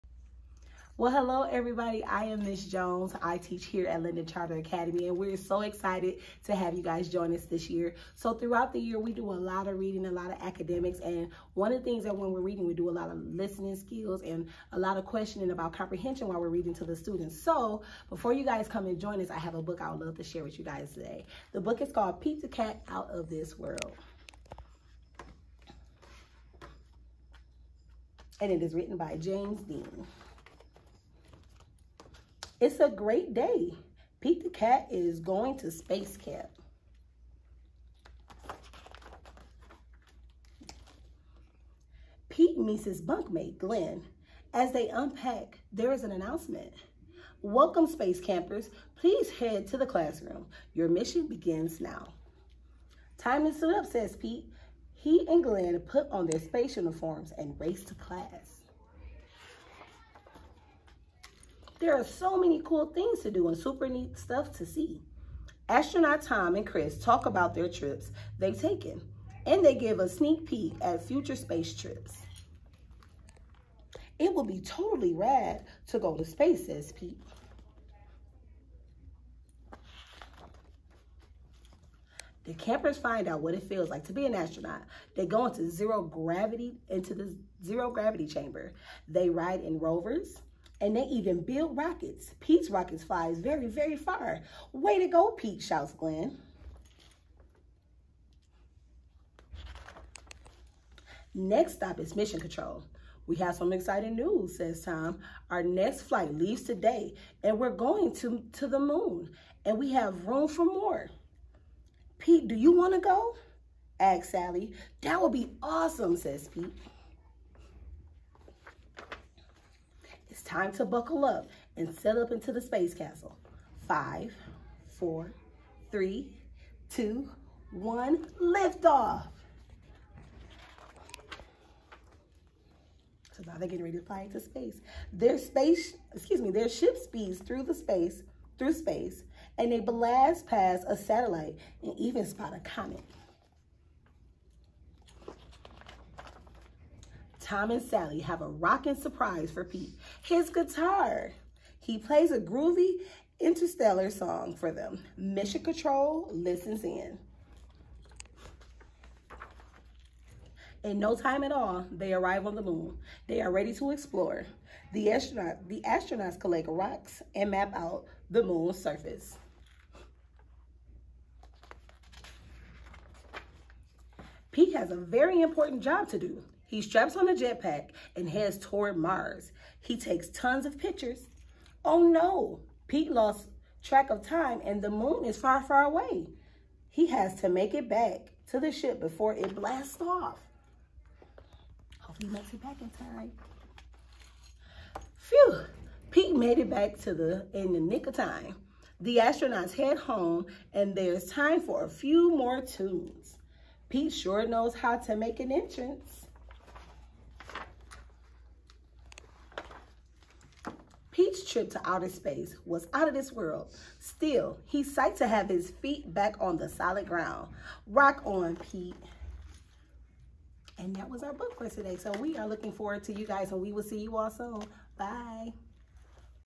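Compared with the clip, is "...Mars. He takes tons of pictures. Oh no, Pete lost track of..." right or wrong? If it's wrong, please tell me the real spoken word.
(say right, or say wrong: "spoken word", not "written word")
right.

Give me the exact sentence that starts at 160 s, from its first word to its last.
In no time at all, they arrive on the moon.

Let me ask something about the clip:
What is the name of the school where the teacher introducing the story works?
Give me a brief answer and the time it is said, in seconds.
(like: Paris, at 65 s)
Linden Charter Academy, at 4 s.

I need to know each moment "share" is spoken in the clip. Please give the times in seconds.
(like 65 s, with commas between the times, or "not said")
20 s.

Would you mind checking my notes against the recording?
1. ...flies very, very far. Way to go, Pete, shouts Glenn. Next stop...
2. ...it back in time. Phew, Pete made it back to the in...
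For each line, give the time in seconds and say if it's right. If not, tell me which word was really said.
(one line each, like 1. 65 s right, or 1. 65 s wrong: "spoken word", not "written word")
1. 93 s right
2. 192 s right.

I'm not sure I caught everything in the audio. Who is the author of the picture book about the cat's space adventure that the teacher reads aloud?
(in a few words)
James Dean.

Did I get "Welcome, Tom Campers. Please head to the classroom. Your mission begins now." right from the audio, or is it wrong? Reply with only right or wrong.
wrong.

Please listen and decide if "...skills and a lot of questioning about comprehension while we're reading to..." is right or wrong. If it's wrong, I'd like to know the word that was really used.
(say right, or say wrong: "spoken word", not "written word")
right.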